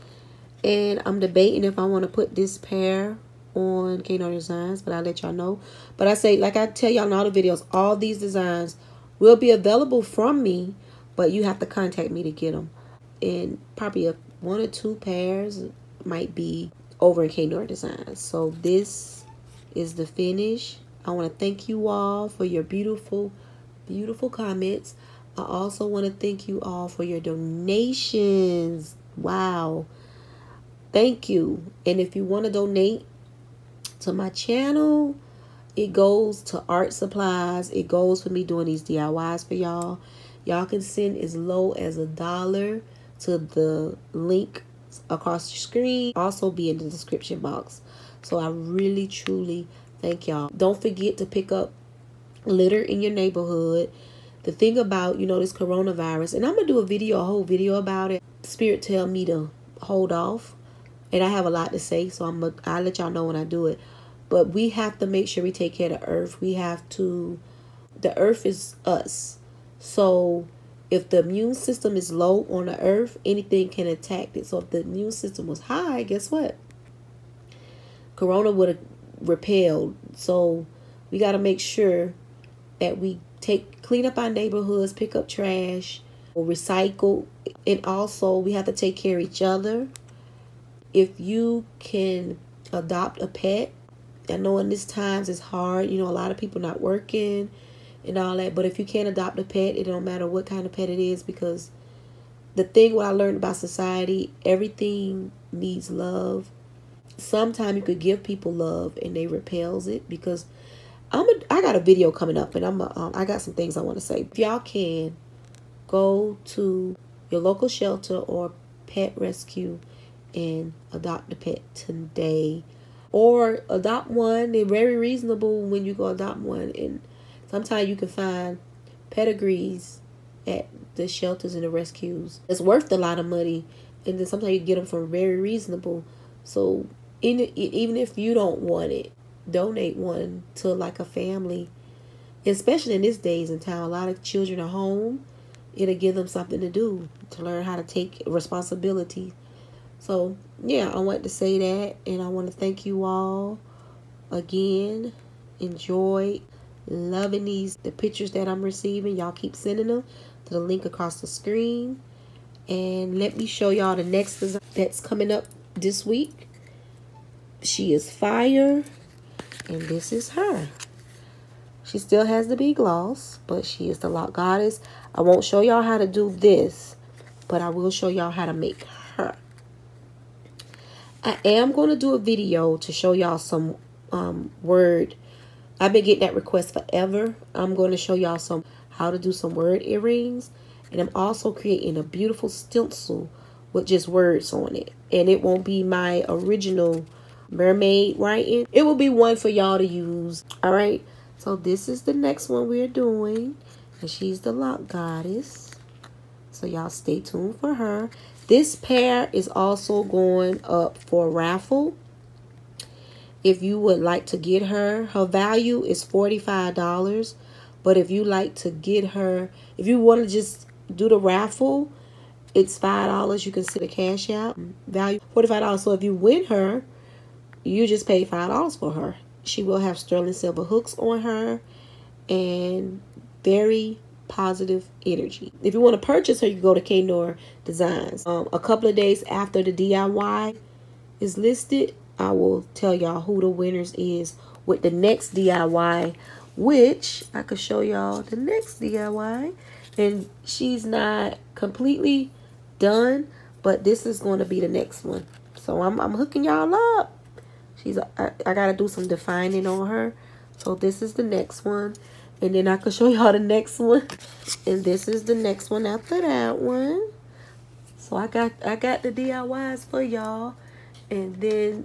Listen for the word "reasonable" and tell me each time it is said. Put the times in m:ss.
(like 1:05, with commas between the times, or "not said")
2:04, 2:15.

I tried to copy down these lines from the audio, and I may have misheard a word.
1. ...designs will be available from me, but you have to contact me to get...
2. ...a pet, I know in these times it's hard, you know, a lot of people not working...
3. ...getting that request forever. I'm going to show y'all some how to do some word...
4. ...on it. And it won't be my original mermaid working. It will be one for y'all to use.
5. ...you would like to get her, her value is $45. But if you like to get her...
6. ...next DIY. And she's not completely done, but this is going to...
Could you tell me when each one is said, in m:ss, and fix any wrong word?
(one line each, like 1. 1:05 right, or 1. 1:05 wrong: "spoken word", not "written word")
1. 0:08 right
2. 1:33 right
3. 3:06 right
4. 3:14 wrong: "writing", not "working"
5. 3:33 right
6. 4:08 right.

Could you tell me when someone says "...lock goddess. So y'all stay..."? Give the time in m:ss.
3:24.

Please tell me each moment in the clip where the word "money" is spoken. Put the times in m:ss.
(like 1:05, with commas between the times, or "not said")
2:13.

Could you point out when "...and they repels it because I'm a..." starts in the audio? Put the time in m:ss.
1:49.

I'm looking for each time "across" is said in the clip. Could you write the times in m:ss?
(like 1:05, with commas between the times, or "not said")
0:45, 2:40.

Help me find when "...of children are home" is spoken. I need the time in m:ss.
2:24.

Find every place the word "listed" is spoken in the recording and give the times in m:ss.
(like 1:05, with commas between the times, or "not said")
4:01.